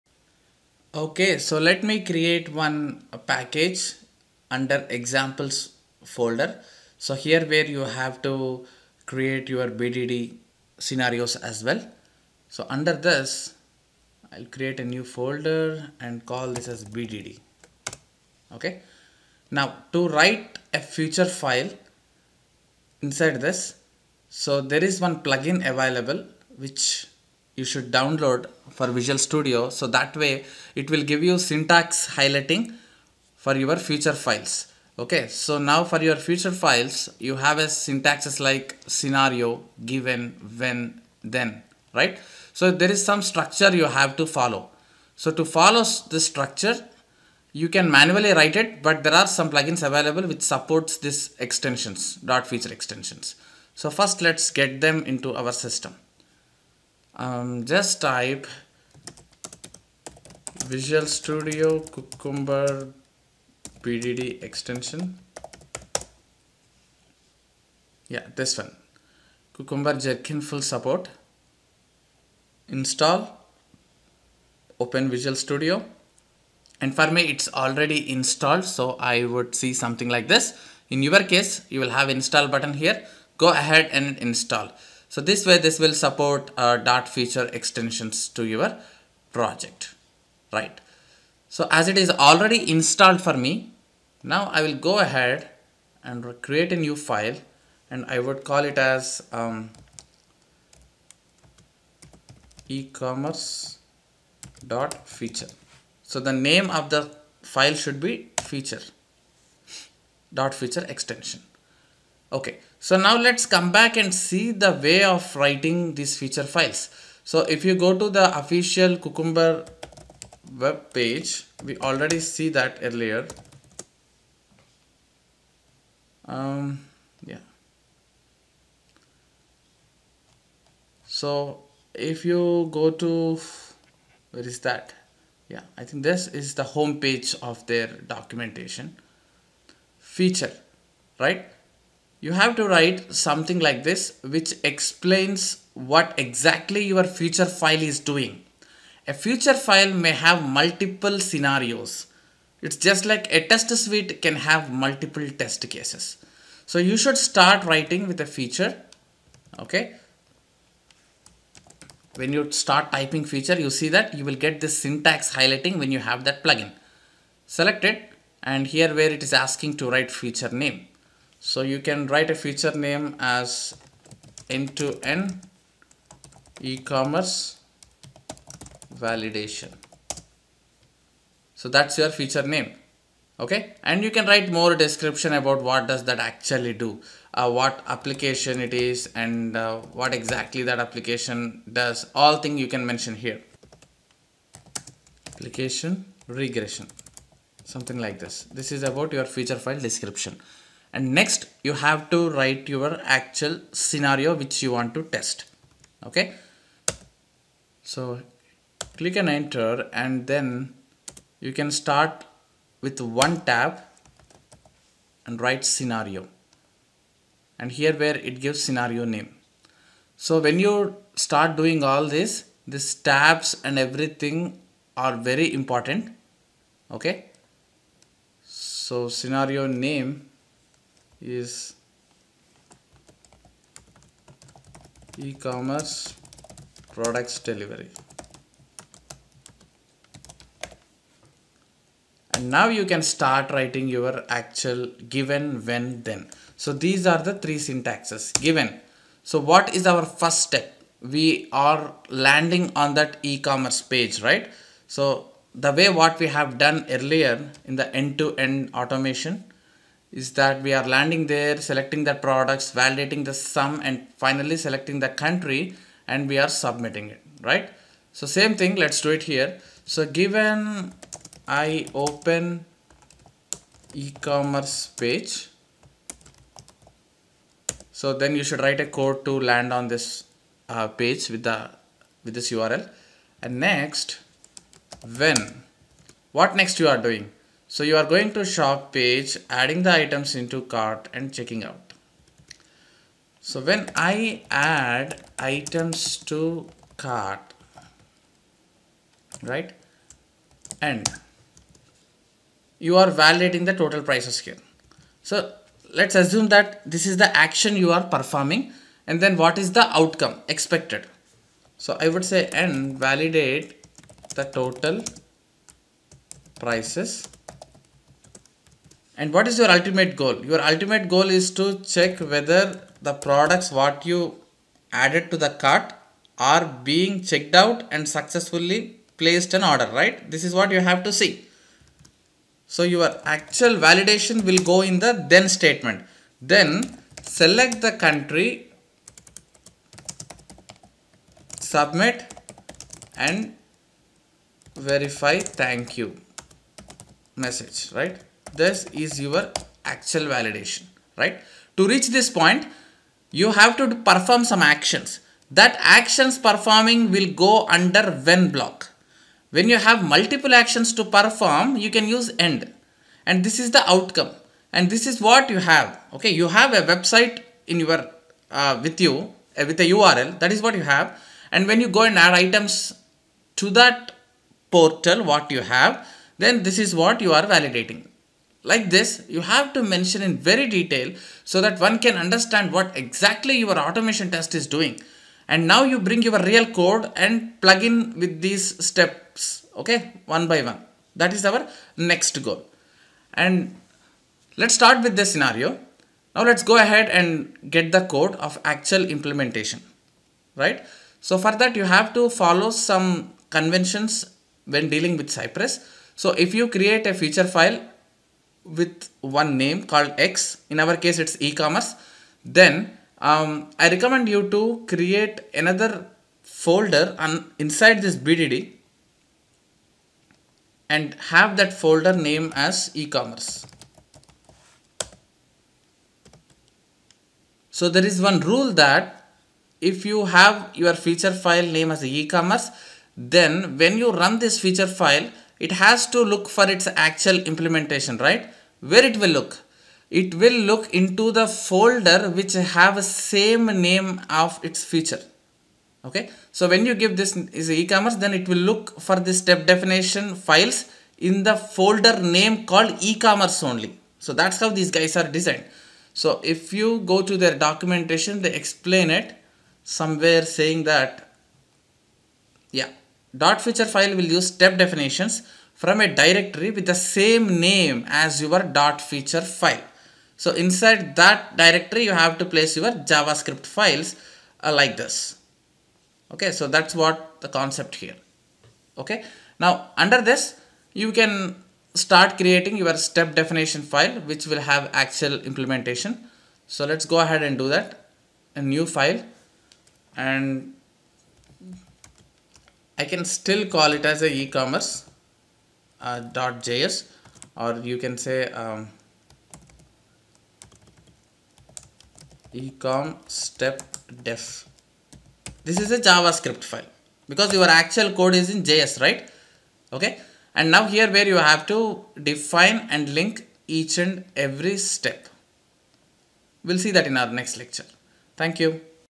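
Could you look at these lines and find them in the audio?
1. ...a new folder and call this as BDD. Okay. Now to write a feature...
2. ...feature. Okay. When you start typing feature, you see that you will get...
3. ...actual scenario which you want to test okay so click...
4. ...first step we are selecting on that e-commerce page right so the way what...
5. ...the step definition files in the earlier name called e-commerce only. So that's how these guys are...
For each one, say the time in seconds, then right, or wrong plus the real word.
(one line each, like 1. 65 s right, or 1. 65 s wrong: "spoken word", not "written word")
1. 14 s right
2. 158 s right
3. 203 s right
4. 250 s wrong: "landing", not "selecting"
5. 449 s wrong: "folder", not "earlier".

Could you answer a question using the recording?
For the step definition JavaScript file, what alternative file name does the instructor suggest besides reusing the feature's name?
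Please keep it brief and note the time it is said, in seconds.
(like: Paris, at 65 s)
ecom step def, at 502 s.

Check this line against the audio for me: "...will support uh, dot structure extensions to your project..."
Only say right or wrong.
wrong.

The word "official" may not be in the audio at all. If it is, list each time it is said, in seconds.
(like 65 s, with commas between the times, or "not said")
118 s.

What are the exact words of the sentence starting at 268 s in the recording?
So same thing, let's do it here.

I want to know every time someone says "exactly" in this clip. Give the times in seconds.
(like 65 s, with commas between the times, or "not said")
146 s, 190 s, 382 s.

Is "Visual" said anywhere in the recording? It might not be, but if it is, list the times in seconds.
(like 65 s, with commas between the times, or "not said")
28 s, 60 s, 75 s.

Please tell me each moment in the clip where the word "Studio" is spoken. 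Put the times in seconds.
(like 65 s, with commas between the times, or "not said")
29 s, 61 s, 75 s.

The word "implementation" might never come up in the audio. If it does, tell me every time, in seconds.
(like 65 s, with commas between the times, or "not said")
399 s, 437 s, 485 s.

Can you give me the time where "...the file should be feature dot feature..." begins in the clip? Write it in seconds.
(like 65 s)
106 s.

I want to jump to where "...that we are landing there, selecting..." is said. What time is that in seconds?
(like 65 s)
260 s.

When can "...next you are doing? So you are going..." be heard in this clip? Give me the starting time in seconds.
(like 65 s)
286 s.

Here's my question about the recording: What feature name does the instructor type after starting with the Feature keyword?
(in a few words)
End-to-end e-commerce validation.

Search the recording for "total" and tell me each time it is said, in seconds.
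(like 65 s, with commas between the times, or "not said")
303 s, 314 s.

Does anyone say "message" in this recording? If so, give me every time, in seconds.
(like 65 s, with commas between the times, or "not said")
347 s.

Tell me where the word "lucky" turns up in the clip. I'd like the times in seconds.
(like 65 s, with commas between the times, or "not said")
not said.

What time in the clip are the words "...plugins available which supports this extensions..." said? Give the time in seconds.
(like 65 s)
49 s.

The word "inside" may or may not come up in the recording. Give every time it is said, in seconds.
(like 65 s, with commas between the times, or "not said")
23 s, 417 s, 470 s.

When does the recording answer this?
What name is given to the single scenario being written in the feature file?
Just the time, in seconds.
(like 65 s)
235 s.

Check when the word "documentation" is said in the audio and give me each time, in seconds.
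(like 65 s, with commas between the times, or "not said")
138 s, 457 s.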